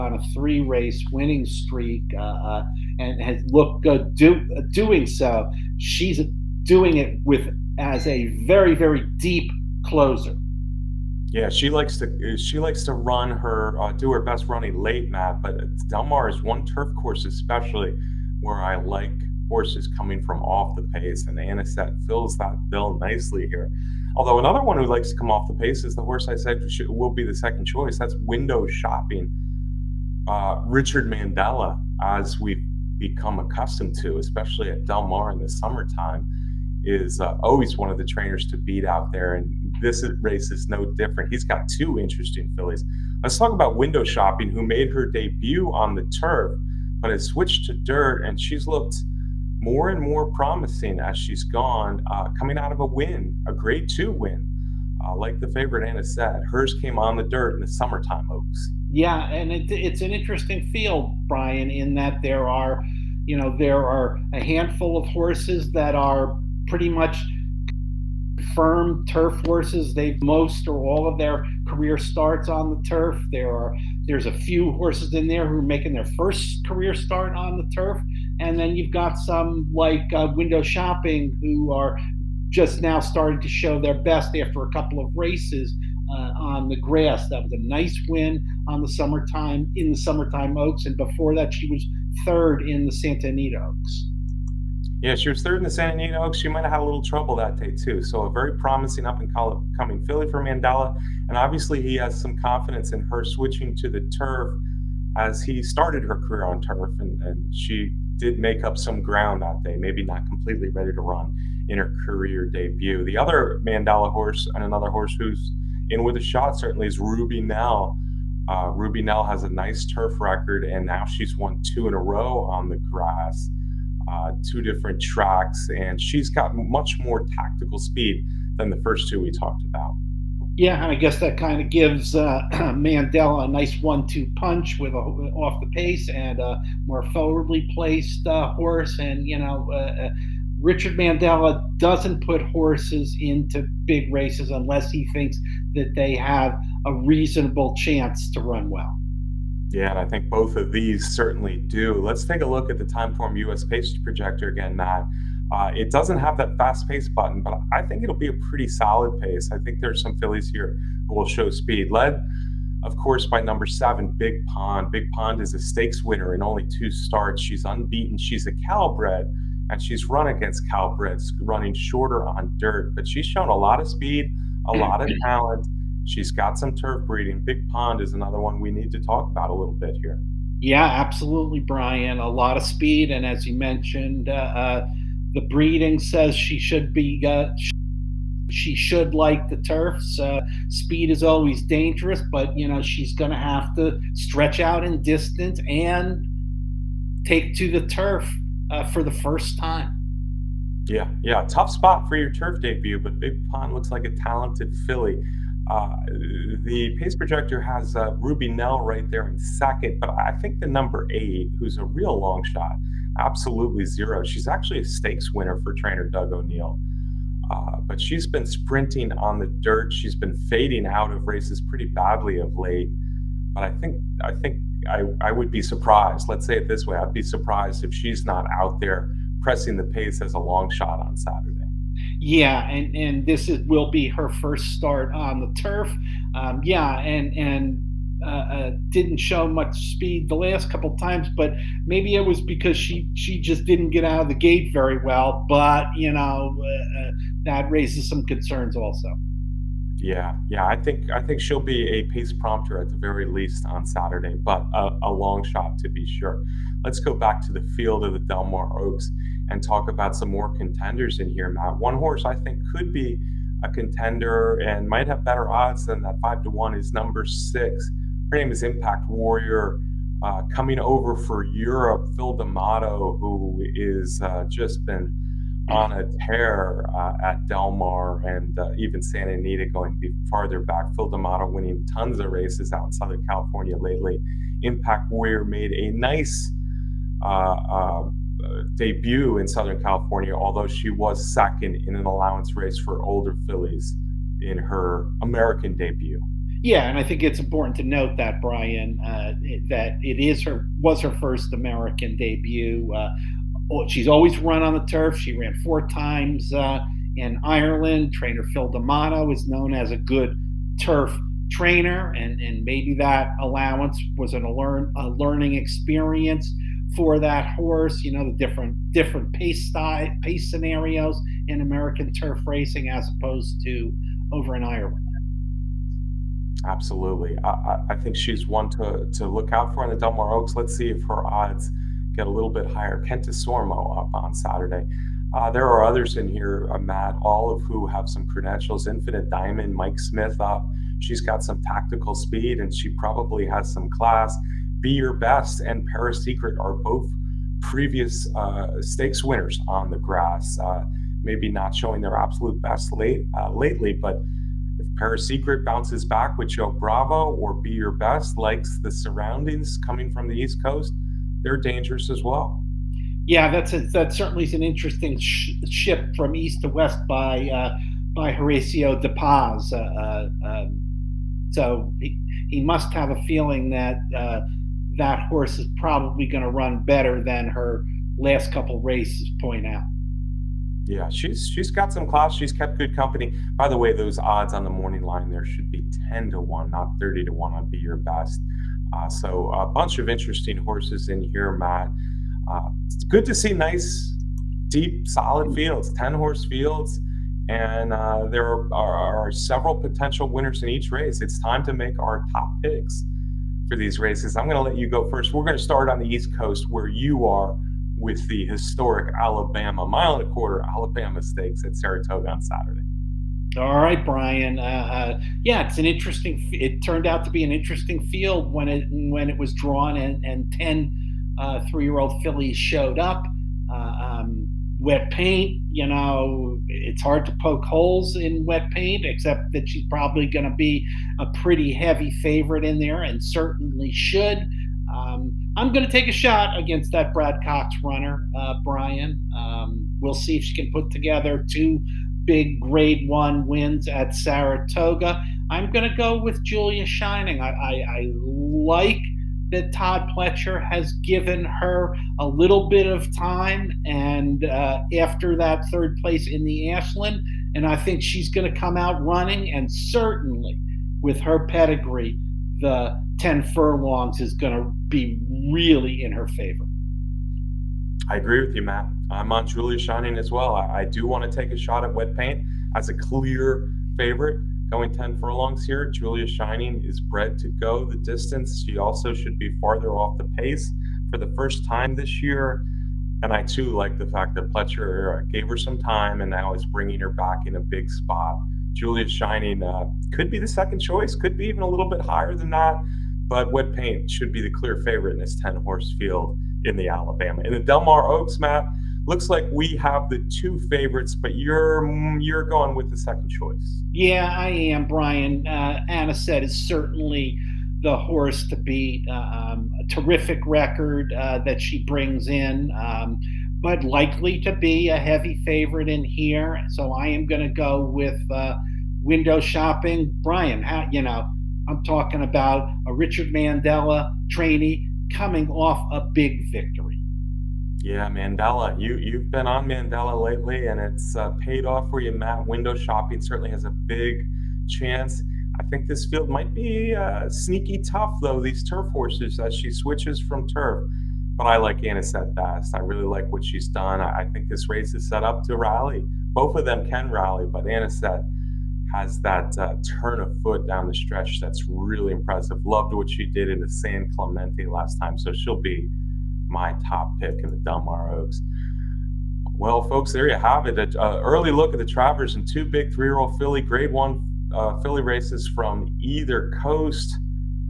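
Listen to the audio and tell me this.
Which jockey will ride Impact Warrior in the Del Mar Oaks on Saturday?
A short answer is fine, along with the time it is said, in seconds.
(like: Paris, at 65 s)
Kent Desormeaux, at 332 s.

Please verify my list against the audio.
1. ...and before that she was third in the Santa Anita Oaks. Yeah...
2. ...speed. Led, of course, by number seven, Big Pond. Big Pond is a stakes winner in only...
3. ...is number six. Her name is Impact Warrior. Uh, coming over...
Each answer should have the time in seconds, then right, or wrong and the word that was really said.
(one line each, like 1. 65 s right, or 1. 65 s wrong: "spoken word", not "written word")
1. 90 s right
2. 161 s right
3. 266 s right.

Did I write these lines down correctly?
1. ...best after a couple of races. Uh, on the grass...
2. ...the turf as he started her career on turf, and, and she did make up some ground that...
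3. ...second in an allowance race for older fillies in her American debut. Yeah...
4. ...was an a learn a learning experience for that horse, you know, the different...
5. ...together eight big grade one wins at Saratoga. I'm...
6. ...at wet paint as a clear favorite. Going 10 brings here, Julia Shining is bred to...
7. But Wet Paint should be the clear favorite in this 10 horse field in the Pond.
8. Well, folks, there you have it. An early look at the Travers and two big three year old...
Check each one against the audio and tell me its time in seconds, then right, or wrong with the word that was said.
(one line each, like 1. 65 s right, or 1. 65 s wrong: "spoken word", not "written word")
1. 84 s right
2. 103 s right
3. 291 s right
4. 314 s right
5. 440 s wrong: "two", not "eight"
6. 471 s wrong: "furlongs", not "brings"
7. 493 s wrong: "Alabama", not "Pond"
8. 559 s right.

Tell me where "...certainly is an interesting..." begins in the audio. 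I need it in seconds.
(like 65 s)
364 s.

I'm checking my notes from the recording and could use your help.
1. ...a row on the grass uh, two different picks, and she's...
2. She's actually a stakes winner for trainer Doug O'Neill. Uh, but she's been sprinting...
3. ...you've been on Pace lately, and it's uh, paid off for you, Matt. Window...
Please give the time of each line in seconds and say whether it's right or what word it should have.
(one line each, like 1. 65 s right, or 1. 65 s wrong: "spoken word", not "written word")
1. 121 s wrong: "tracks", not "picks"
2. 214 s right
3. 528 s wrong: "Mandella", not "Pace".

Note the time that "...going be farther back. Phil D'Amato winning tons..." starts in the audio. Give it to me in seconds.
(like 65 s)
279 s.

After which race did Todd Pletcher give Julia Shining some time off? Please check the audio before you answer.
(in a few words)
Ashland.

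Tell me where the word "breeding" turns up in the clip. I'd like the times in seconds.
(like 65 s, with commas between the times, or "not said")
177 s, 185 s.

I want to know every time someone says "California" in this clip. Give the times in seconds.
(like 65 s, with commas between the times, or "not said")
283 s, 289 s.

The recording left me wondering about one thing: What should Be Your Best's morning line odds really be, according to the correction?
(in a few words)
10 to 1.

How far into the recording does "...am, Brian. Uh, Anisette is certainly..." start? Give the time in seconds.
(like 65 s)
504 s.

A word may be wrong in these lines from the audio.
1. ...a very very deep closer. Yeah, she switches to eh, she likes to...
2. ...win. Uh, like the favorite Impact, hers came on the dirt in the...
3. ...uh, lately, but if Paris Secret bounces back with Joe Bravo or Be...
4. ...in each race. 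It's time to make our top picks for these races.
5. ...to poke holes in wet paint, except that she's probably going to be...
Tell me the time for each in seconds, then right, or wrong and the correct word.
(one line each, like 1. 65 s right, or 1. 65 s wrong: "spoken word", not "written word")
1. 8 s wrong: "likes", not "switches"
2. 54 s wrong: "Anisette", not "Impact"
3. 353 s right
4. 400 s right
5. 427 s right.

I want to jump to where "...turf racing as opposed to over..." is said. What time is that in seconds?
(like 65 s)
322 s.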